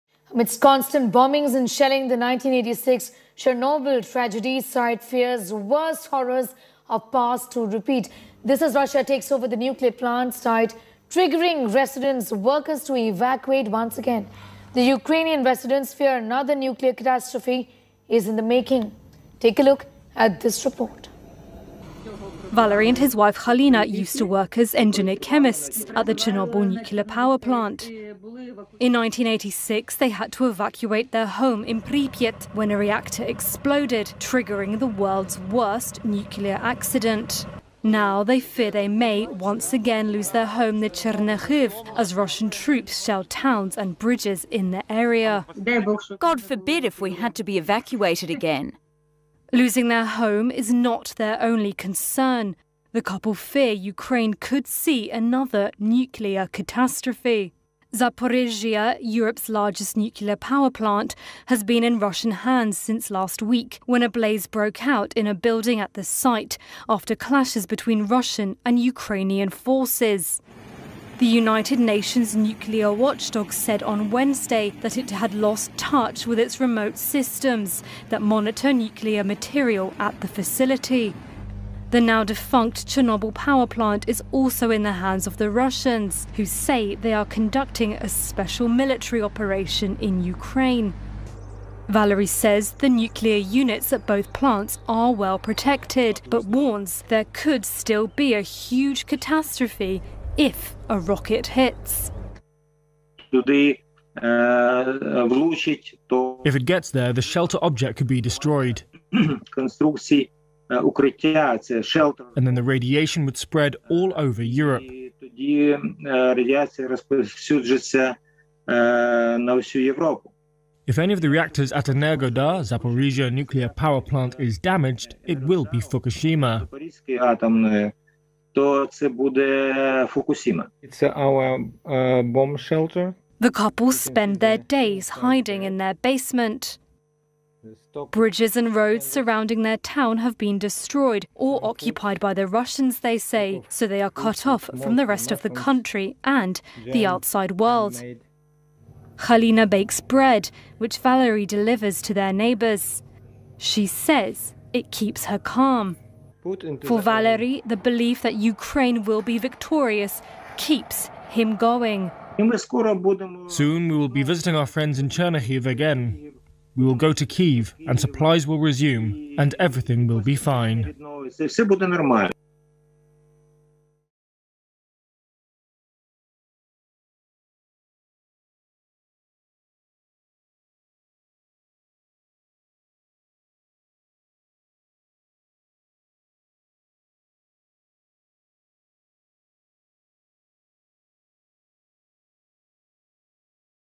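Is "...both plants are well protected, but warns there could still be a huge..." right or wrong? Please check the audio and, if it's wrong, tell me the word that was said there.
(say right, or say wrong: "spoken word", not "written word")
right.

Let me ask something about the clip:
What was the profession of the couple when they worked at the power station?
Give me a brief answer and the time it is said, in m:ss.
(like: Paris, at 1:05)
engineer chemists, at 0:24.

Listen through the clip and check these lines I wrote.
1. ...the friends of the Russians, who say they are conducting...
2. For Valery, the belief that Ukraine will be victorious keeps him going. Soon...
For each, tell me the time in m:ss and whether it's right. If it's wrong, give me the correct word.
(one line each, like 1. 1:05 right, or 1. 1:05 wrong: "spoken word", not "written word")
1. 1:24 wrong: "hands", not "friends"
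2. 2:36 right.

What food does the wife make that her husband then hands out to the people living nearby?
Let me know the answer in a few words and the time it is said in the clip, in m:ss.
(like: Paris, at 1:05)
bread, at 2:30.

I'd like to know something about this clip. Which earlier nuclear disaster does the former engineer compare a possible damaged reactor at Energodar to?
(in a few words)
Fukushima.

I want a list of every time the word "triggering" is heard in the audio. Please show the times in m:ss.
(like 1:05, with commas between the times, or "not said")
0:11, 0:34.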